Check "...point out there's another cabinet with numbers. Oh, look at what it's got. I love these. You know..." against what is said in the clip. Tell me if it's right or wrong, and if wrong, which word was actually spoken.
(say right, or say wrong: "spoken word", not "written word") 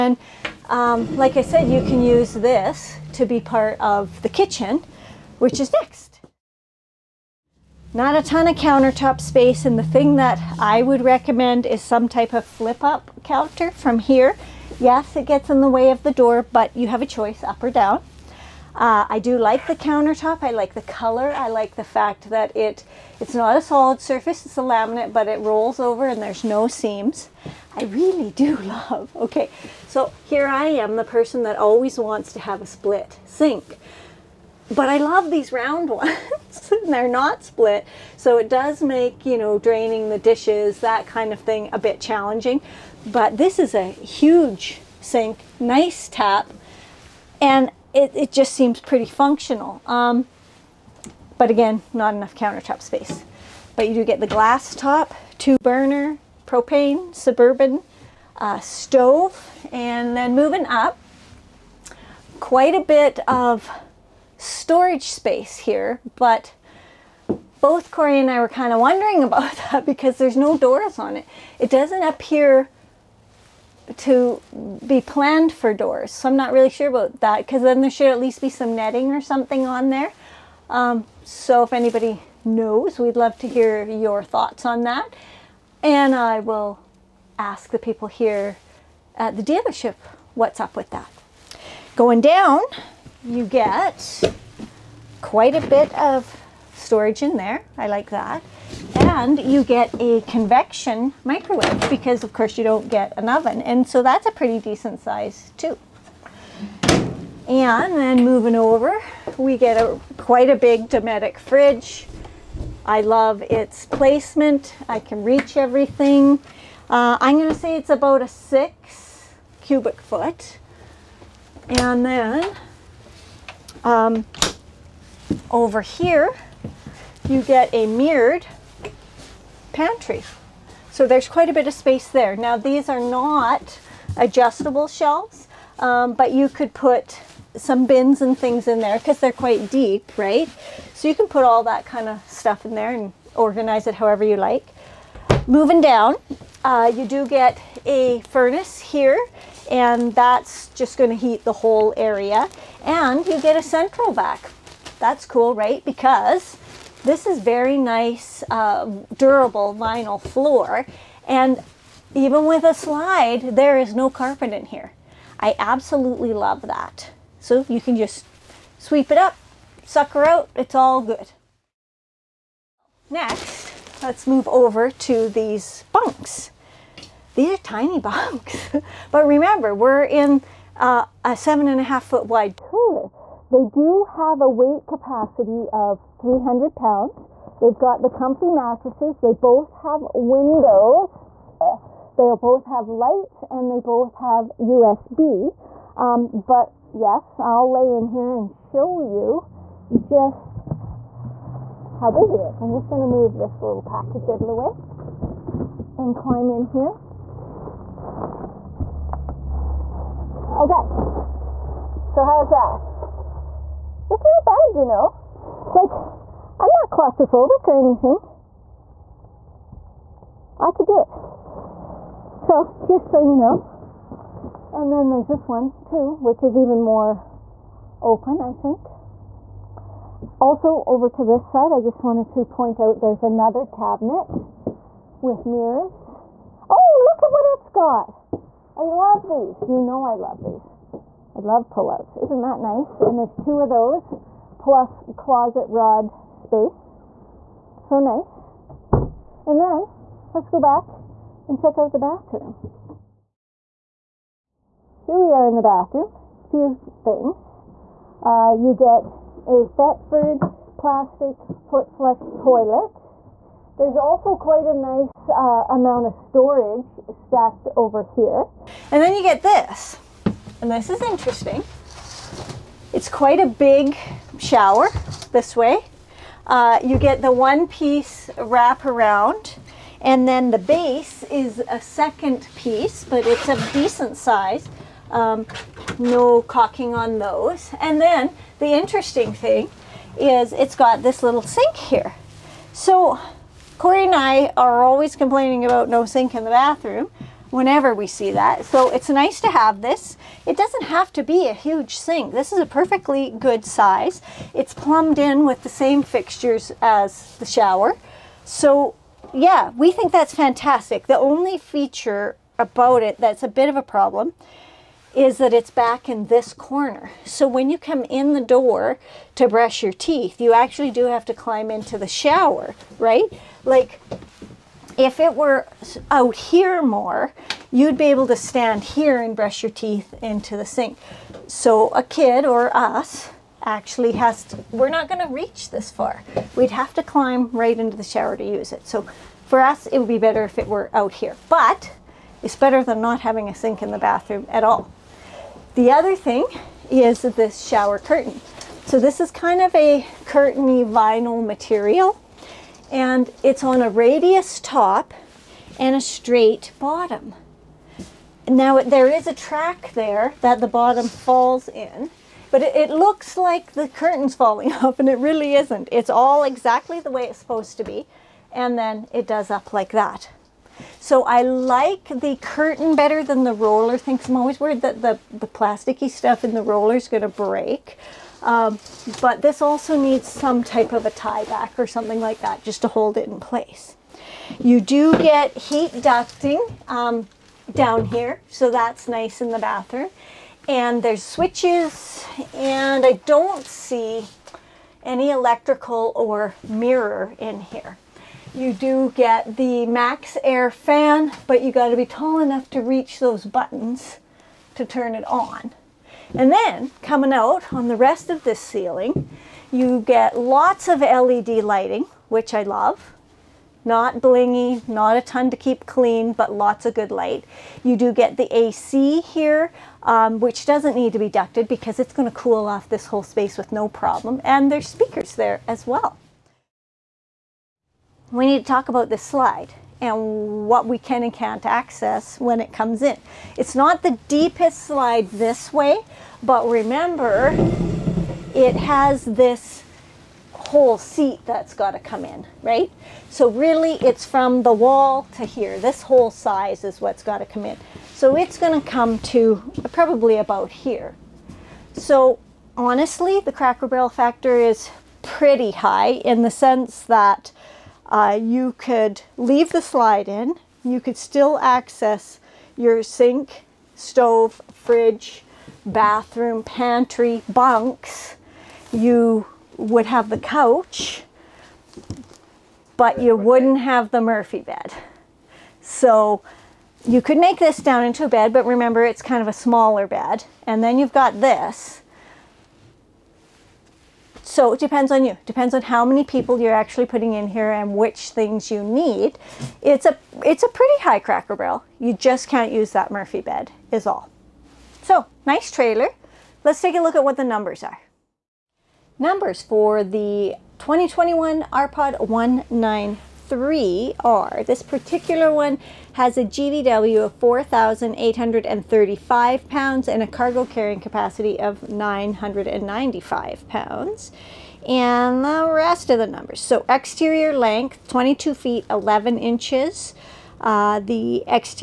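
wrong: "mirrors", not "numbers".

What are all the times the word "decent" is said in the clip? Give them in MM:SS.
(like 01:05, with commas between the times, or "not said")
01:44, 04:43.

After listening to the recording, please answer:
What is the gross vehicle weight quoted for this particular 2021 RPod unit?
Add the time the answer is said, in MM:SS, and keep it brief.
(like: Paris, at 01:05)
4,835 pounds, at 08:27.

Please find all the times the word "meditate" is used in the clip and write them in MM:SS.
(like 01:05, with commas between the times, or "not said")
not said.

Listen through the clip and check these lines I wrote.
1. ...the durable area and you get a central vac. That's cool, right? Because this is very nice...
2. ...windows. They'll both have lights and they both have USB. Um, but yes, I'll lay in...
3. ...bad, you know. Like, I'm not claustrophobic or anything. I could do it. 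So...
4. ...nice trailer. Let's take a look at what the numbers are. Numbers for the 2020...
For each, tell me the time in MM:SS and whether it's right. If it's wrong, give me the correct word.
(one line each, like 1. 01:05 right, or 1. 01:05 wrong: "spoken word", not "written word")
1. 02:31 wrong: "whole", not "durable"
2. 03:10 right
3. 03:34 right
4. 08:15 wrong: "2021", not "2020".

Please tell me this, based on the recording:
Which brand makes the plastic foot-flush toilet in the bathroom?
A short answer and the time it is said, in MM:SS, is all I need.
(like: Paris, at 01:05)
Thetford, at 04:19.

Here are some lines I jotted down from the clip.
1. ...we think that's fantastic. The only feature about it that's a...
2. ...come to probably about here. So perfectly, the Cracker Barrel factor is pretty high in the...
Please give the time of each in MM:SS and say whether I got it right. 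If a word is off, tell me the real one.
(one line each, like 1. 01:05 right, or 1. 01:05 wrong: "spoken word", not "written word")
1. 05:09 right
2. 07:28 wrong: "honestly", not "perfectly".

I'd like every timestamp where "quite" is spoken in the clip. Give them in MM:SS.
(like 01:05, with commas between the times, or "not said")
01:02, 01:35, 01:50, 02:11, 02:19, 04:24, 04:33.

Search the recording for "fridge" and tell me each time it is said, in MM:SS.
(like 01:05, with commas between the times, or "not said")
01:51, 07:44.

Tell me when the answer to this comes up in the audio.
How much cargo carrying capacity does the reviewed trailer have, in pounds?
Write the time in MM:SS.
08:31.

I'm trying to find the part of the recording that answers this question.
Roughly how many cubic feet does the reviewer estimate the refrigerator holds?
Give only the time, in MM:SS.
01:58.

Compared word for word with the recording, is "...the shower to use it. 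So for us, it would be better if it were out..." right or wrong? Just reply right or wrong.
right.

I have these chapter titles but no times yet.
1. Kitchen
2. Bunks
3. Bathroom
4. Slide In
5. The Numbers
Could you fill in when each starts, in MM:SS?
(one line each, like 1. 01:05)
1. 00:06
2. 02:51
3. 04:12
4. 07:07
5. 08:17.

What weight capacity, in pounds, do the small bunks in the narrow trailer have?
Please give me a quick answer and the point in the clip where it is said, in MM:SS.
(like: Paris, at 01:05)
300 pounds, at 03:06.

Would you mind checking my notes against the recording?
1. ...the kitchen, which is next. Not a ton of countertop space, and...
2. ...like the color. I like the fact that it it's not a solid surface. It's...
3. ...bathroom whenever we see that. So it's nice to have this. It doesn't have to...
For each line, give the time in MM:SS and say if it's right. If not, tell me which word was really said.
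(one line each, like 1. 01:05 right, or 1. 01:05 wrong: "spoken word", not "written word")
1. 00:04 right
2. 00:20 right
3. 04:56 right.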